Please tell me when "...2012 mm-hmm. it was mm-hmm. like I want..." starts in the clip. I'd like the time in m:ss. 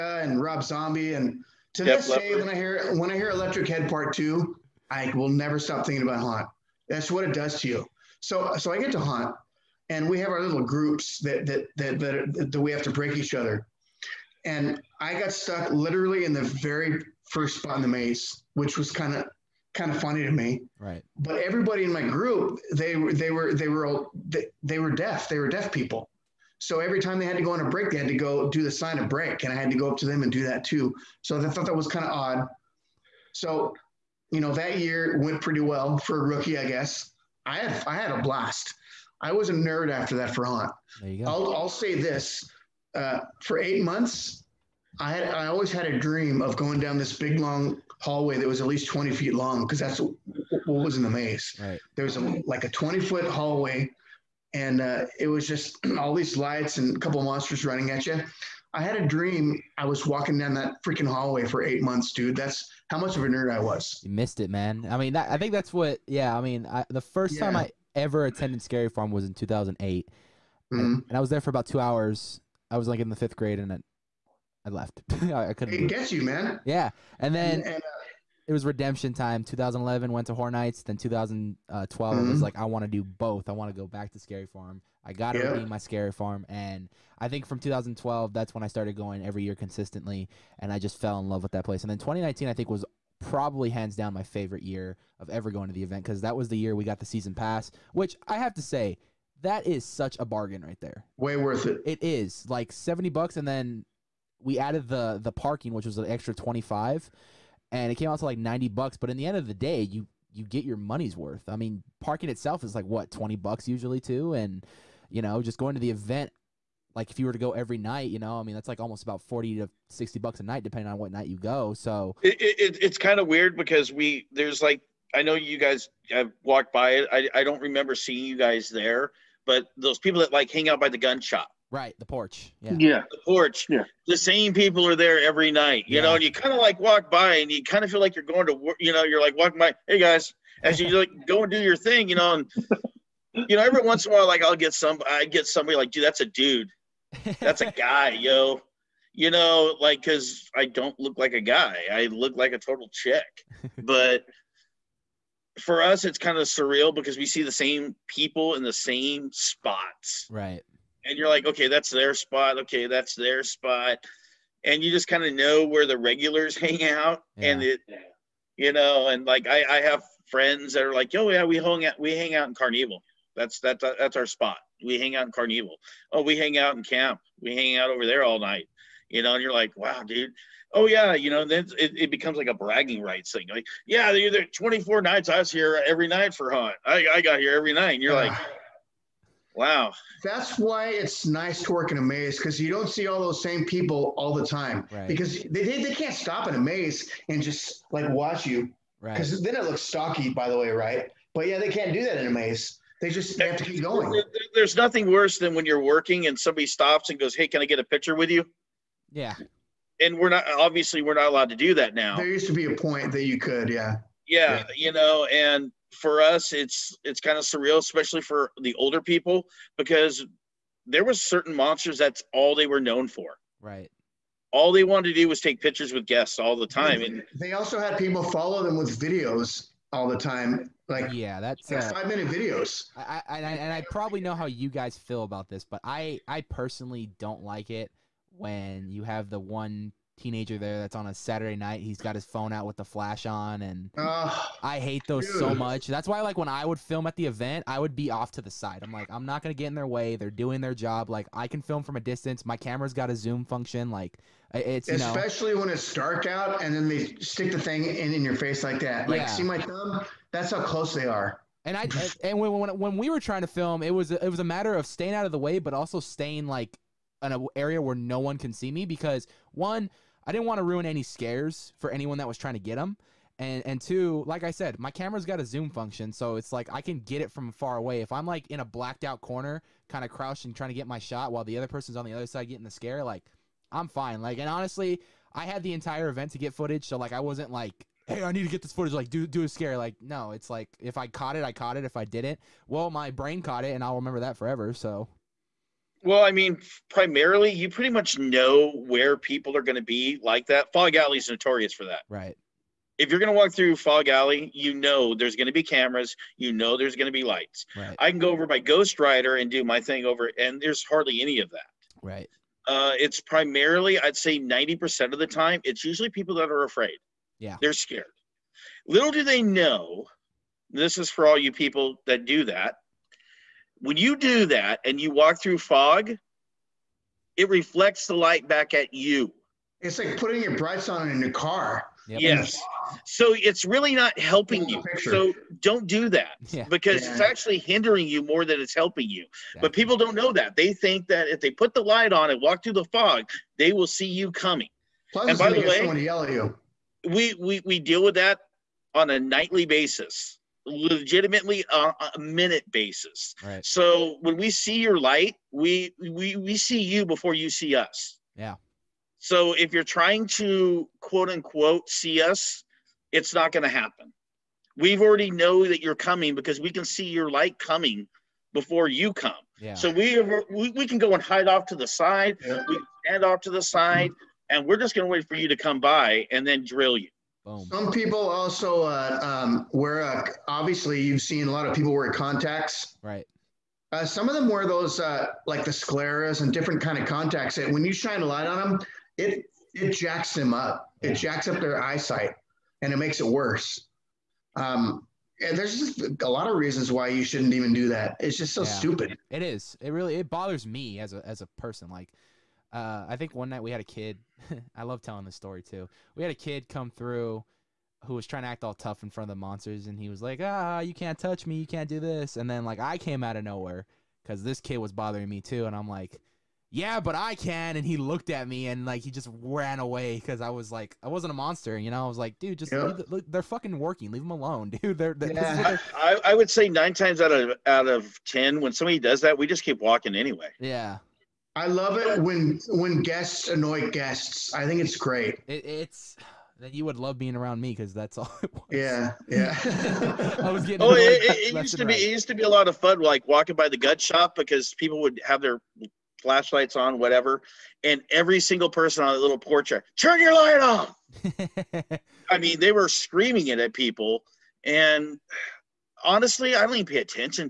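1:20.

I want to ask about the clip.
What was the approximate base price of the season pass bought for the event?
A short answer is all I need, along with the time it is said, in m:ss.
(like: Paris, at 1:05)
$70, at 1:42.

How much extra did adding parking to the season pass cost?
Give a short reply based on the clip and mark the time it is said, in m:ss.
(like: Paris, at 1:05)
$25, at 1:45.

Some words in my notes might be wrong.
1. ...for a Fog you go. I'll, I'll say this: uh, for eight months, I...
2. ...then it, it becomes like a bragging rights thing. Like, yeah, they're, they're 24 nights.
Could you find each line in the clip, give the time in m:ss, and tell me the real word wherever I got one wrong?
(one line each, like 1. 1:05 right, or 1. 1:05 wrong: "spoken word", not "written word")
1. 0:40 wrong: "There", not "Fog"
2. 3:01 right.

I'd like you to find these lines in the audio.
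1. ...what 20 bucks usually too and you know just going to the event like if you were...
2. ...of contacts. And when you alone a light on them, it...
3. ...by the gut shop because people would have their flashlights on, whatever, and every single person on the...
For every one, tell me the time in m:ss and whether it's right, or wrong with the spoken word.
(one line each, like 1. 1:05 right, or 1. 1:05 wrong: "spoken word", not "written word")
1. 1:52 right
2. 6:26 wrong: "shine", not "alone"
3. 7:23 right.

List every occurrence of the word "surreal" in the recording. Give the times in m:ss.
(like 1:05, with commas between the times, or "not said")
2:36, 3:37.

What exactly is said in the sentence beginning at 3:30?
And we're not, obviously, we're not allowed to do that now.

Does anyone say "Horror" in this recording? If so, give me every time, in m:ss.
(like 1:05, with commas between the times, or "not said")
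1:20.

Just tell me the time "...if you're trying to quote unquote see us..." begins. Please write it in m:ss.
5:59.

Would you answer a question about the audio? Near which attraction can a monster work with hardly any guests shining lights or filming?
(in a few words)
Ghost Rider.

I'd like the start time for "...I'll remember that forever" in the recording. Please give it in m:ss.
4:53.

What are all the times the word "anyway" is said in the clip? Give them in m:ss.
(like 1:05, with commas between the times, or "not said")
7:10.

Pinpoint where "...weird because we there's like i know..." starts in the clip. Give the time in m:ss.
2:03.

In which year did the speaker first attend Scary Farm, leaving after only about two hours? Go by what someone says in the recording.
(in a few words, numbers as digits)
2008.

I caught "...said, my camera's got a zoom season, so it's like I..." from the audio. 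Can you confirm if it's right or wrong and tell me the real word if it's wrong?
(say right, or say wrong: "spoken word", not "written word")
wrong: "function", not "season".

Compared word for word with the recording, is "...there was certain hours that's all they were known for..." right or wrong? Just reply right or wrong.
wrong.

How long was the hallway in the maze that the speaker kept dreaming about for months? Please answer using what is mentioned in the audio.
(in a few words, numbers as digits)
20 feet.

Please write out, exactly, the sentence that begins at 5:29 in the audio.
It's like putting your brights on in a car.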